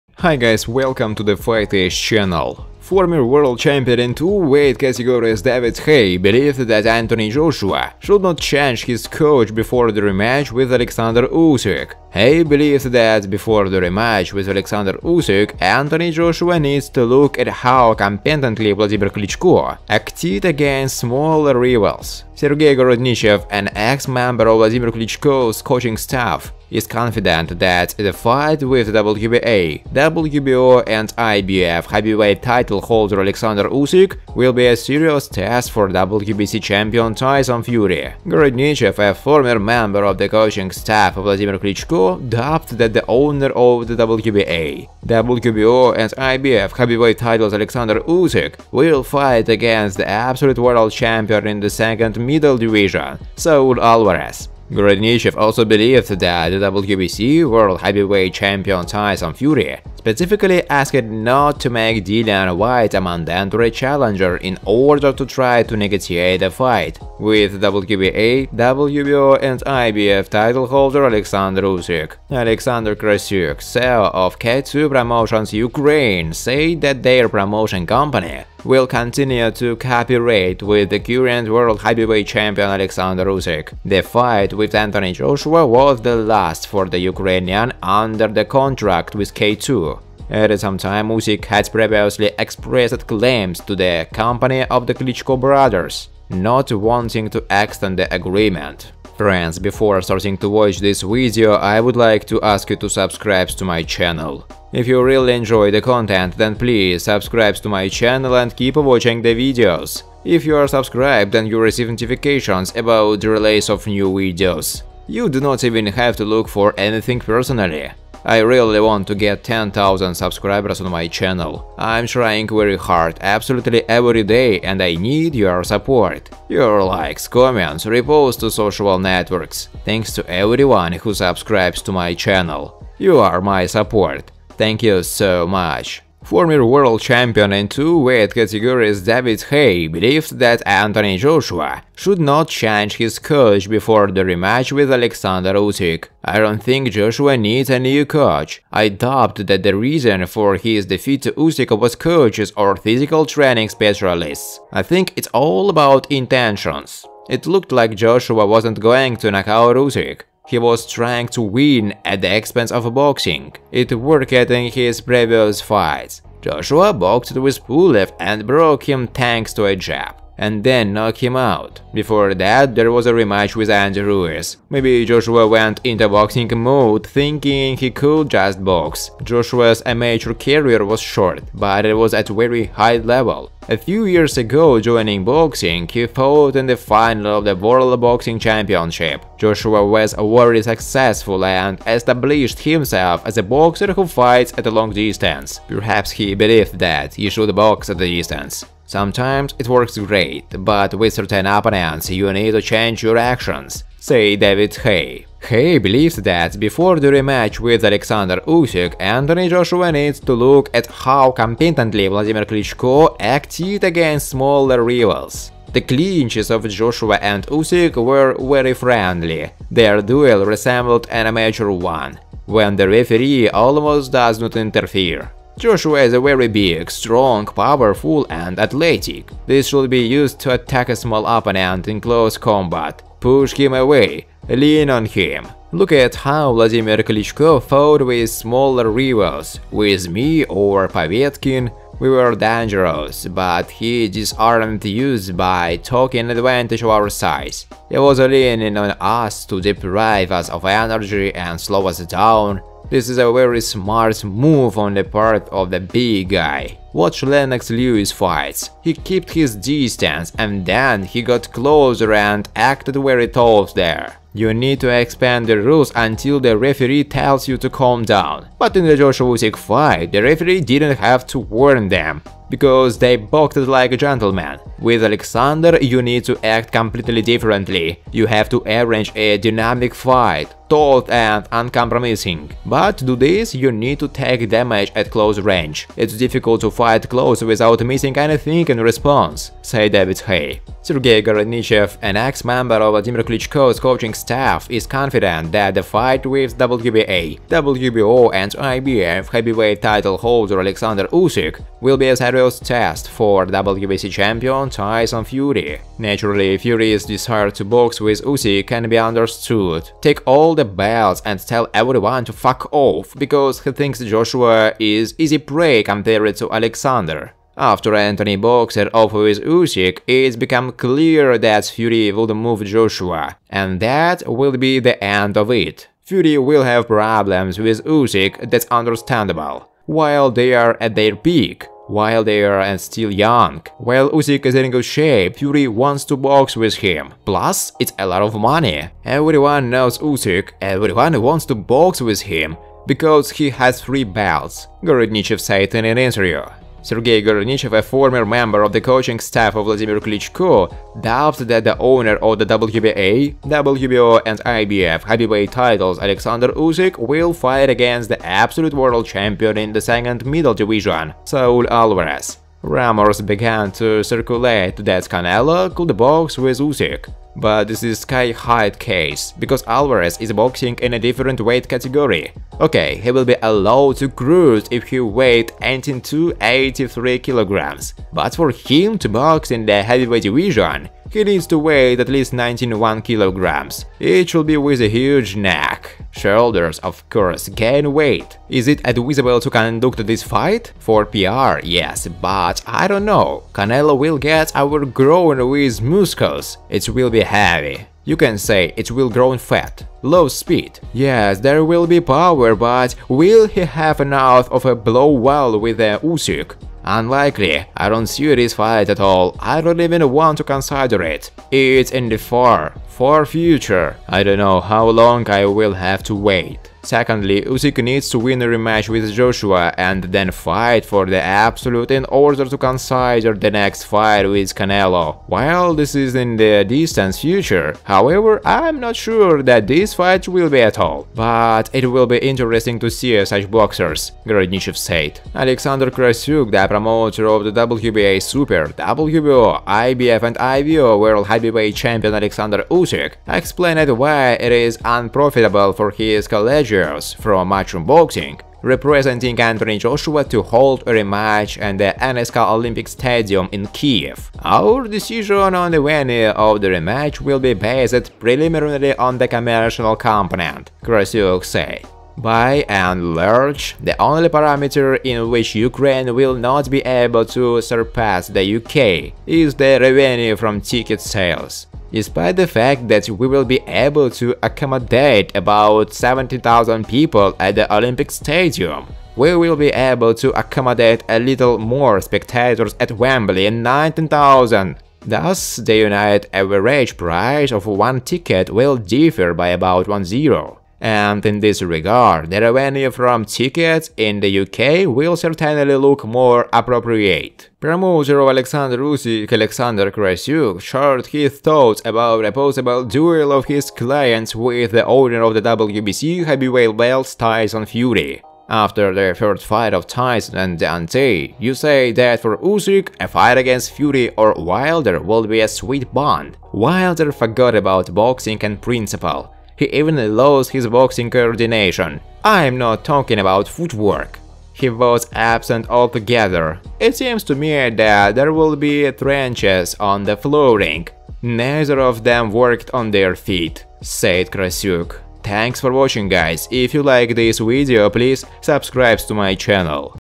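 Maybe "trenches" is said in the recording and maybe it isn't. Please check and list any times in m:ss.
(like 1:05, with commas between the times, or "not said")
8:48.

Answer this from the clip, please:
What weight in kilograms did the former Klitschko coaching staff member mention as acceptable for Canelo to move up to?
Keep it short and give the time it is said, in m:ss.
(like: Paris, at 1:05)
83 kilograms, at 6:15.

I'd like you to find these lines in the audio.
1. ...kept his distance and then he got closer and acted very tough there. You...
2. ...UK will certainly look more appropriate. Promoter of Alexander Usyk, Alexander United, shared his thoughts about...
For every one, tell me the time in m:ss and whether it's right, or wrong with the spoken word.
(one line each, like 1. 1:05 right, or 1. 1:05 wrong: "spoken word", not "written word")
1. 4:18 right
2. 8:14 wrong: "Krasyuk", not "United".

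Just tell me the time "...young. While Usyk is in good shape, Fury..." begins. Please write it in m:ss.
5:33.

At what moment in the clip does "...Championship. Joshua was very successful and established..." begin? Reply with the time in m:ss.
3:08.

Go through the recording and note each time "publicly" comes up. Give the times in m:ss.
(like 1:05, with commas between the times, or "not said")
not said.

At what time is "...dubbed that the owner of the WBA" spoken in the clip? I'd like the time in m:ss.
0:42.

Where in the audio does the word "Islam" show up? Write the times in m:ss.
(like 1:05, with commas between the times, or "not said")
not said.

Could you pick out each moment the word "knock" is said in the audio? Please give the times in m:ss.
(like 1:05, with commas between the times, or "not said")
2:39, 2:50.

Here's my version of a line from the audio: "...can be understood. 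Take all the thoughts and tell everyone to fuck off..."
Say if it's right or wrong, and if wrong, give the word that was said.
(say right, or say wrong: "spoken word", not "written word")
wrong: "belts", not "thoughts".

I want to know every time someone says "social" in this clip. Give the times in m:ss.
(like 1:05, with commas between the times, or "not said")
2:08.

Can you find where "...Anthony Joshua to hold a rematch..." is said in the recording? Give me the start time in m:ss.
7:29.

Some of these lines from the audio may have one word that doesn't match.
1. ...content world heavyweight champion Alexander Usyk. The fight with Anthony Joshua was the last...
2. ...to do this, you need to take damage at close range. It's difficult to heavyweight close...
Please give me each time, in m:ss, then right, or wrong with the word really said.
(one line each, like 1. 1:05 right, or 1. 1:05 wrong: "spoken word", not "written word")
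1. 1:20 wrong: "current", not "content"
2. 4:42 wrong: "fight", not "heavyweight".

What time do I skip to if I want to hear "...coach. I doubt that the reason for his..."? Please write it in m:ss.
2:28.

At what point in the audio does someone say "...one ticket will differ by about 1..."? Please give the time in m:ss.
8:07.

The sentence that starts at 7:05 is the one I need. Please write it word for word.
While this is in the distant future, however, I'm not sure that this fight will be at all.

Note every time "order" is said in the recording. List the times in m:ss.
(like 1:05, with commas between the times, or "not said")
1:04, 7:02.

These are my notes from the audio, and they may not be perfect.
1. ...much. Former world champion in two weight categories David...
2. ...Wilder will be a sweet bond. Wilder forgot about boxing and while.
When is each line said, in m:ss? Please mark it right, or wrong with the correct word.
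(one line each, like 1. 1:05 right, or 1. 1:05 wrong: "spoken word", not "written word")
1. 2:15 right
2. 8:34 wrong: "principle", not "while".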